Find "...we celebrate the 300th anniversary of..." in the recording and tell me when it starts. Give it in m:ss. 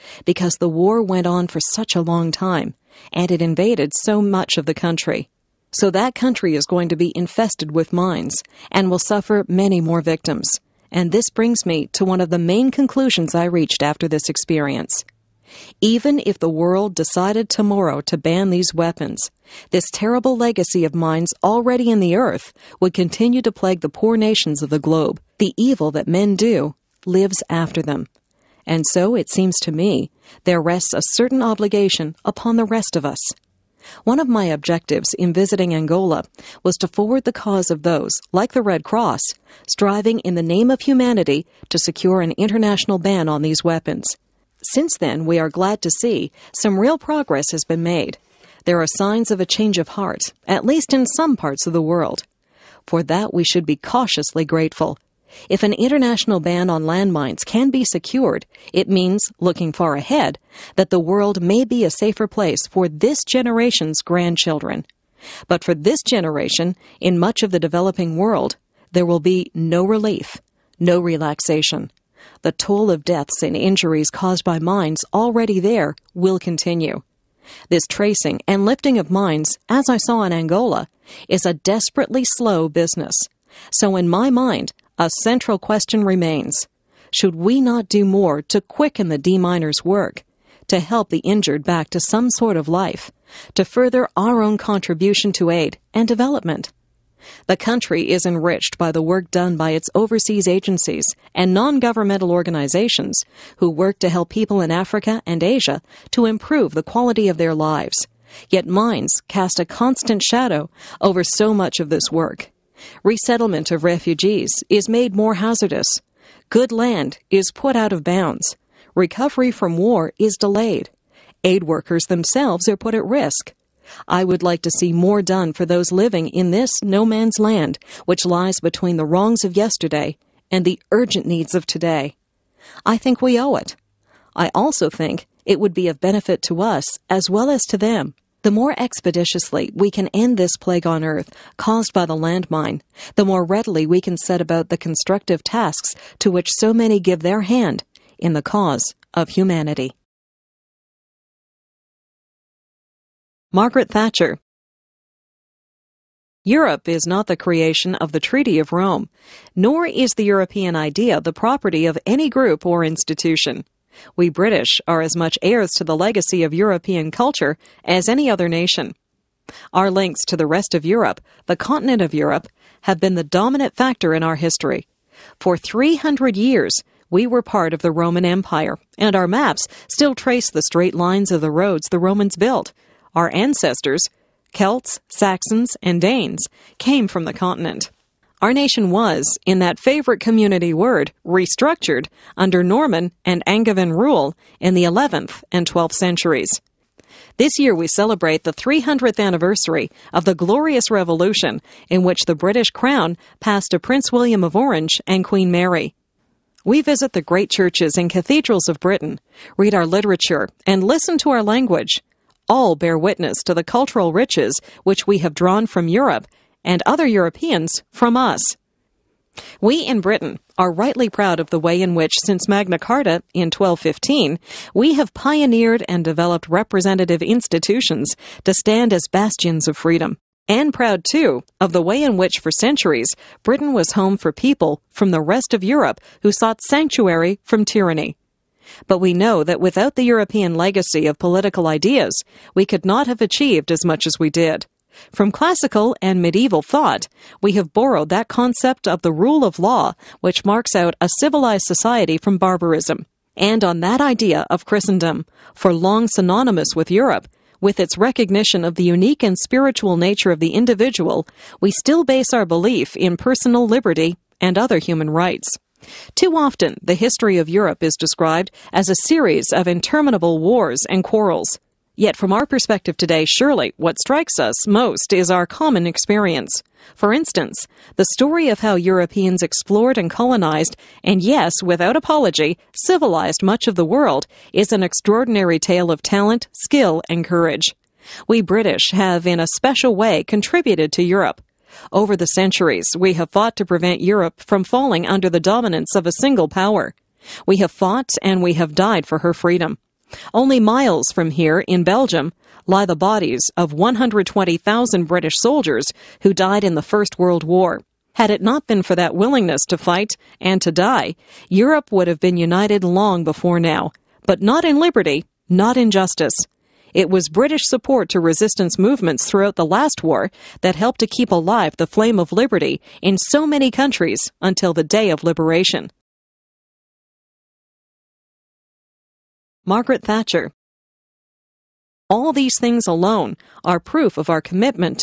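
3:17.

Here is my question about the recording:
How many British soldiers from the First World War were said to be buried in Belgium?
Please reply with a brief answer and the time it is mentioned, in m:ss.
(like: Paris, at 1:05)
120,000, at 5:03.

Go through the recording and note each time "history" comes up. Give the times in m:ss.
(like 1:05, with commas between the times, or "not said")
2:54, 4:26.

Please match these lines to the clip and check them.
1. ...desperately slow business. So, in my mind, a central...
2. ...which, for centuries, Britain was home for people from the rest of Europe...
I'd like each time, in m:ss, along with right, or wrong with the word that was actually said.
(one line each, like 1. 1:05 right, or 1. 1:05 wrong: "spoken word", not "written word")
1. 1:21 right
2. 3:52 right.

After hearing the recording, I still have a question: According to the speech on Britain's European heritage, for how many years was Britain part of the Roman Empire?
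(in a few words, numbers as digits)
300.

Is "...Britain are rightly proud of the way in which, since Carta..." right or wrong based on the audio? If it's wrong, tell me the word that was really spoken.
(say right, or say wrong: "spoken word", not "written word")
wrong: "Magna", not "Carta".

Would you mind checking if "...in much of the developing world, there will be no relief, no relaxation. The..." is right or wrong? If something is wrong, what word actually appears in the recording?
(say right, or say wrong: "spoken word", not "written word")
right.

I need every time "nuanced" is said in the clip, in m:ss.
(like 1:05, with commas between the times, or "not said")
not said.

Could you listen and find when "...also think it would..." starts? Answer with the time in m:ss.
2:14.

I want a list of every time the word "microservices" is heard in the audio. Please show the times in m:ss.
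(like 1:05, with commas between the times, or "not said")
not said.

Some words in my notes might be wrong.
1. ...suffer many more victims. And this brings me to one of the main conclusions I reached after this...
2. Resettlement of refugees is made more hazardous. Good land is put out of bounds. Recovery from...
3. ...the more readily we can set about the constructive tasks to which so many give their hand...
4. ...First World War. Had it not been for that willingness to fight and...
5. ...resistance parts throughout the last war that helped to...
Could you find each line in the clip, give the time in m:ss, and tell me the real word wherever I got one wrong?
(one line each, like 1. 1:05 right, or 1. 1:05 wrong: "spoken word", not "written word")
1. 0:08 right
2. 1:53 right
3. 2:23 right
4. 5:06 right
5. 5:18 wrong: "movements", not "parts".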